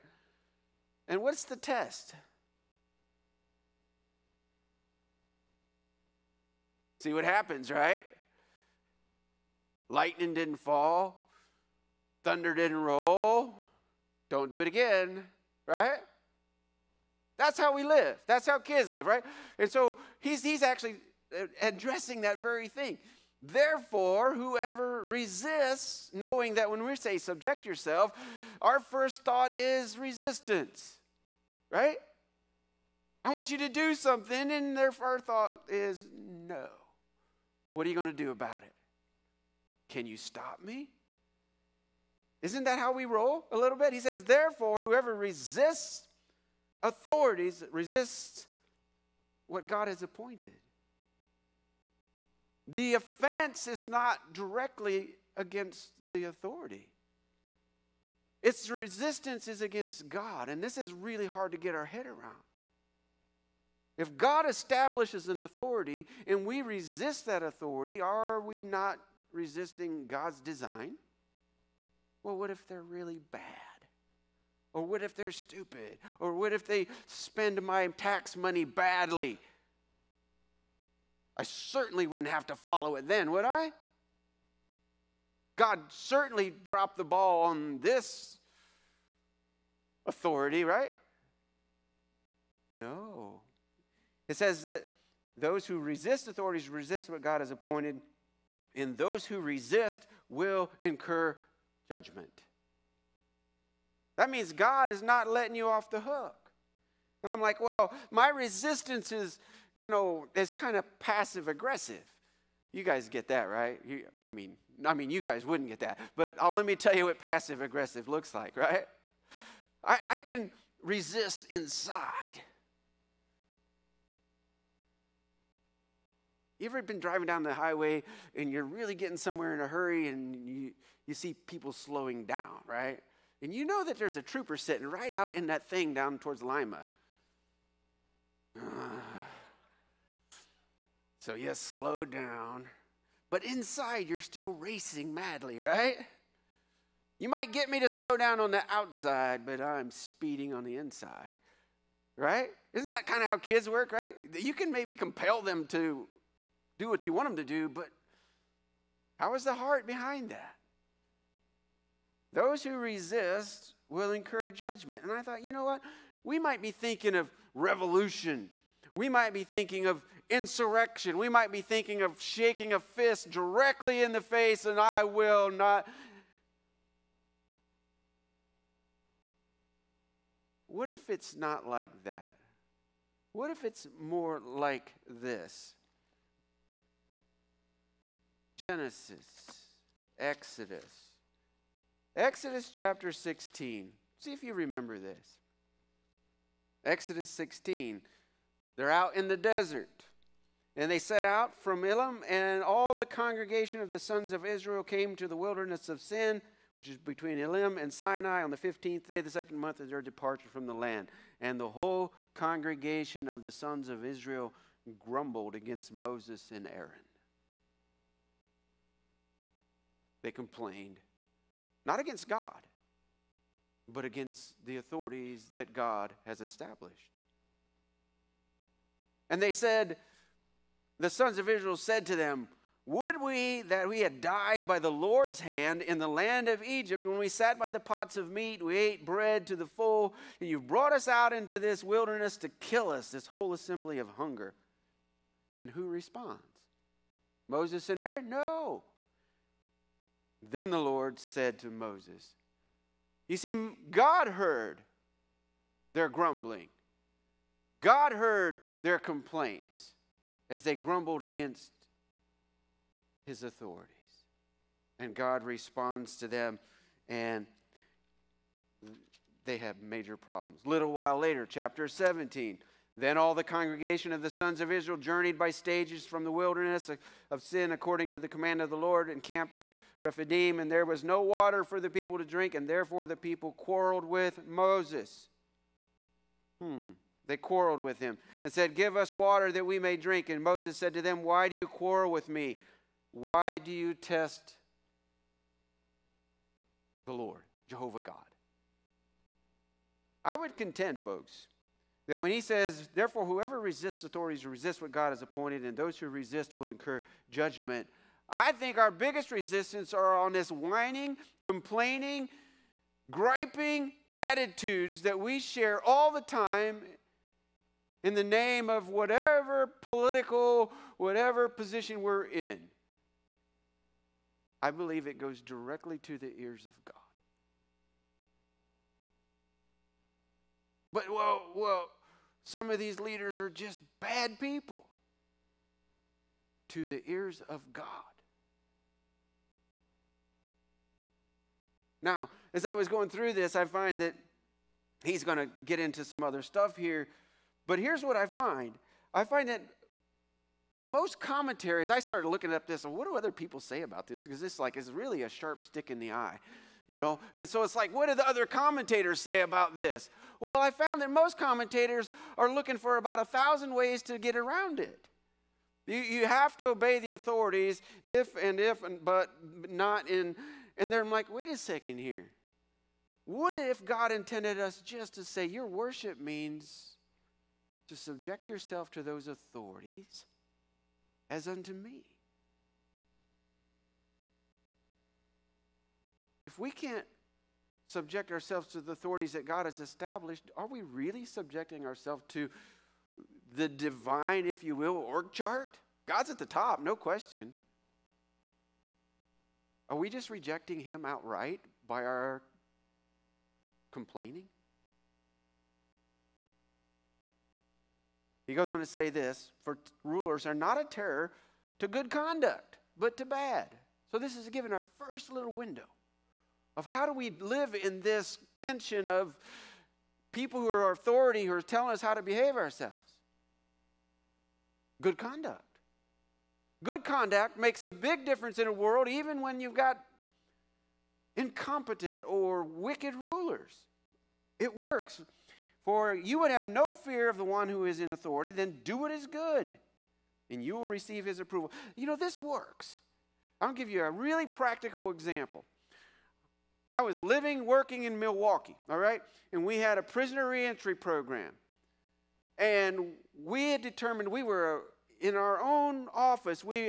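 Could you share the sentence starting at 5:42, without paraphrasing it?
Now, as I was going through this, I find that he's going to get into some other stuff here.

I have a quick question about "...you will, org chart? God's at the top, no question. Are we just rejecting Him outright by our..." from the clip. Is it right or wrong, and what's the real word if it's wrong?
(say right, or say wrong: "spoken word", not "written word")
right.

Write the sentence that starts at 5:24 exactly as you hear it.
I believe it goes directly to the ears of God.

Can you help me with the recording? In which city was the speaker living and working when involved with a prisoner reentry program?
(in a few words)
Milwaukee.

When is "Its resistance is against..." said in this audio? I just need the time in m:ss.
0:58.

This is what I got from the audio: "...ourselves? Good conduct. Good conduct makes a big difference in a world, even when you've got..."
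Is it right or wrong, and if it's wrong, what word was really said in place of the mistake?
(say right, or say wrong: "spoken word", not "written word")
right.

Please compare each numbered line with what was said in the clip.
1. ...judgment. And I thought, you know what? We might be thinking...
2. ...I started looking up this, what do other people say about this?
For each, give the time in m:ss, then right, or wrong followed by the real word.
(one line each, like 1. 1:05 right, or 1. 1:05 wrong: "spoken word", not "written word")
1. 2:44 right
2. 5:51 right.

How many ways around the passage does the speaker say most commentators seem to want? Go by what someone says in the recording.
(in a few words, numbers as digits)
1000.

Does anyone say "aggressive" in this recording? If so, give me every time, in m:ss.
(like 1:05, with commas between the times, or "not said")
1:51, 1:57.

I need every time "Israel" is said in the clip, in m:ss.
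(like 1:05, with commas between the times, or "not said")
3:24, 3:34, 3:51, 4:34.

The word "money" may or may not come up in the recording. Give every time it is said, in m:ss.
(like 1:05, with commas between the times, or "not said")
1:18.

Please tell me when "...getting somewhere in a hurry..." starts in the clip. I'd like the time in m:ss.
2:08.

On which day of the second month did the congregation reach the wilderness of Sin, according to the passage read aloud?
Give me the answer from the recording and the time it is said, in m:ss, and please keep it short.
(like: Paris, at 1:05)
15th, at 3:28.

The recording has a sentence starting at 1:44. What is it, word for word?
That means God is not letting you off the hook.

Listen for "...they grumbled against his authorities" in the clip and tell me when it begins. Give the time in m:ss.
4:20.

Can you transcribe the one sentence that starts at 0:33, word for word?
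I want you to do something, and their first thought is no.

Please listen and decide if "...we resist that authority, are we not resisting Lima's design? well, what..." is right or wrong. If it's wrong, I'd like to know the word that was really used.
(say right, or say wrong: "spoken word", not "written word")
wrong: "God", not "Lima".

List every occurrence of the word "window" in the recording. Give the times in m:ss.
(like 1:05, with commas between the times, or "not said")
6:55.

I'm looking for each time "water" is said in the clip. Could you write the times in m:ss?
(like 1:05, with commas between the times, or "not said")
4:41, 4:49.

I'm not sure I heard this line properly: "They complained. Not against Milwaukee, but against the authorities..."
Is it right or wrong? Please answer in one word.
wrong.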